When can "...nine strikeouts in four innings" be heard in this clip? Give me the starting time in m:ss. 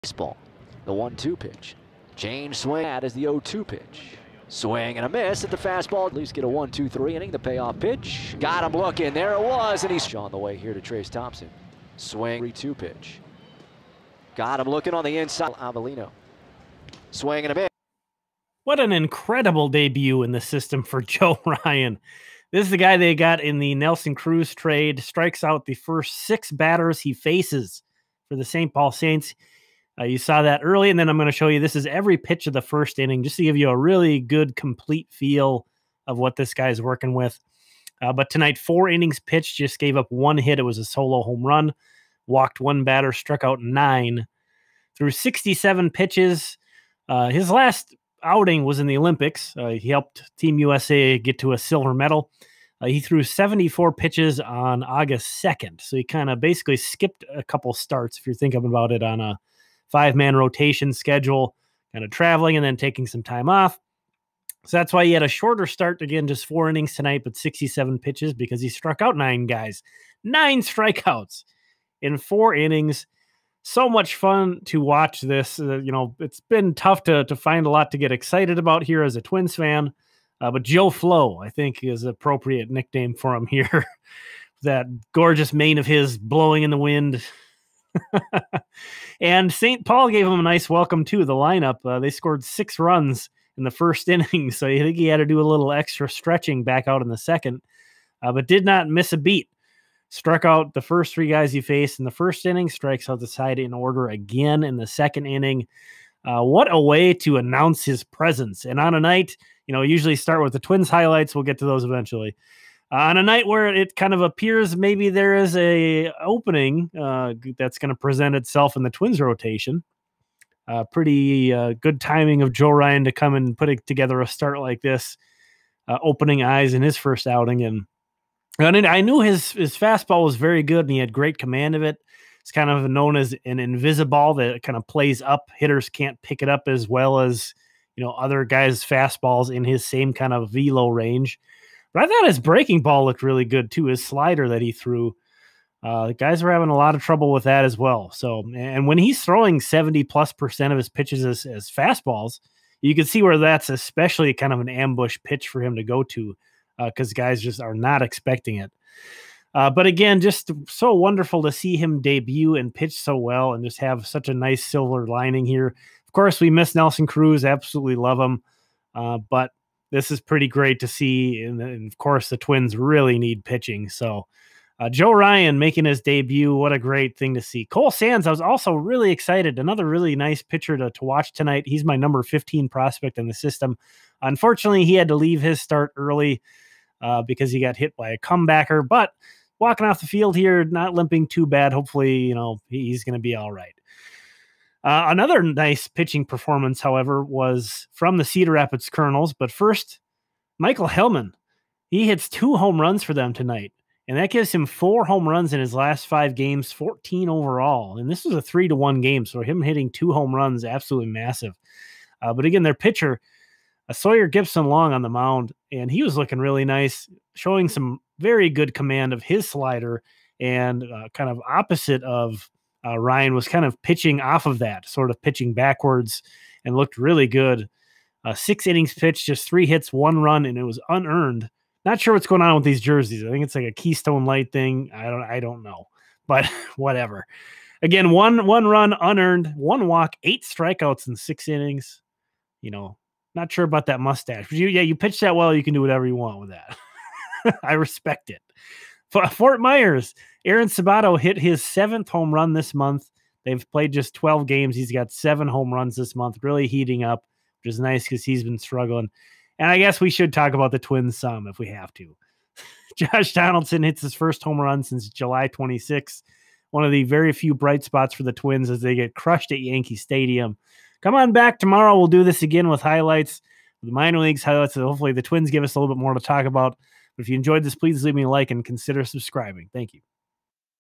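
1:10.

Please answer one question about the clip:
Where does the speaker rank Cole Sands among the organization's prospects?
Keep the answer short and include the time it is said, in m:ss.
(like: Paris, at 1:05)
15, at 3:01.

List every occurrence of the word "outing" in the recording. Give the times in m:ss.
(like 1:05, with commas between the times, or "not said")
0:48, 2:07.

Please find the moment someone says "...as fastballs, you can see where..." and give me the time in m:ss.
2:31.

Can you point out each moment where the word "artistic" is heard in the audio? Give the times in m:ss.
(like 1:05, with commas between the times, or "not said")
not said.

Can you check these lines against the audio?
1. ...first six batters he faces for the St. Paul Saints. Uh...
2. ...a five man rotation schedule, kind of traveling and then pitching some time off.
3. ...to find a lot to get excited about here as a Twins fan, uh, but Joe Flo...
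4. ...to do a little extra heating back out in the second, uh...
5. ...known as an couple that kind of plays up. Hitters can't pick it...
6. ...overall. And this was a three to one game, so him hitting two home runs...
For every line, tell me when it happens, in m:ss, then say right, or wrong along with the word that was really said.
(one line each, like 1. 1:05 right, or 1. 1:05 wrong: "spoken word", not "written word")
1. 0:25 right
2. 0:59 wrong: "taking", not "pitching"
3. 1:17 right
4. 1:35 wrong: "stretching", not "heating"
5. 2:12 wrong: "invisible", not "couple"
6. 3:27 right.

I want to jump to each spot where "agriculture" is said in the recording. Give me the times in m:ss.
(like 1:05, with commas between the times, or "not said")
not said.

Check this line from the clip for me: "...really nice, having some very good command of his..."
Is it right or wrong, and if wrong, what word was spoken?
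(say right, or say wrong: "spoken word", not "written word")
wrong: "showing", not "having".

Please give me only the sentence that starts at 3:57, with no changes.
Again, one one run unearned, one walk, eight strikeouts in six innings.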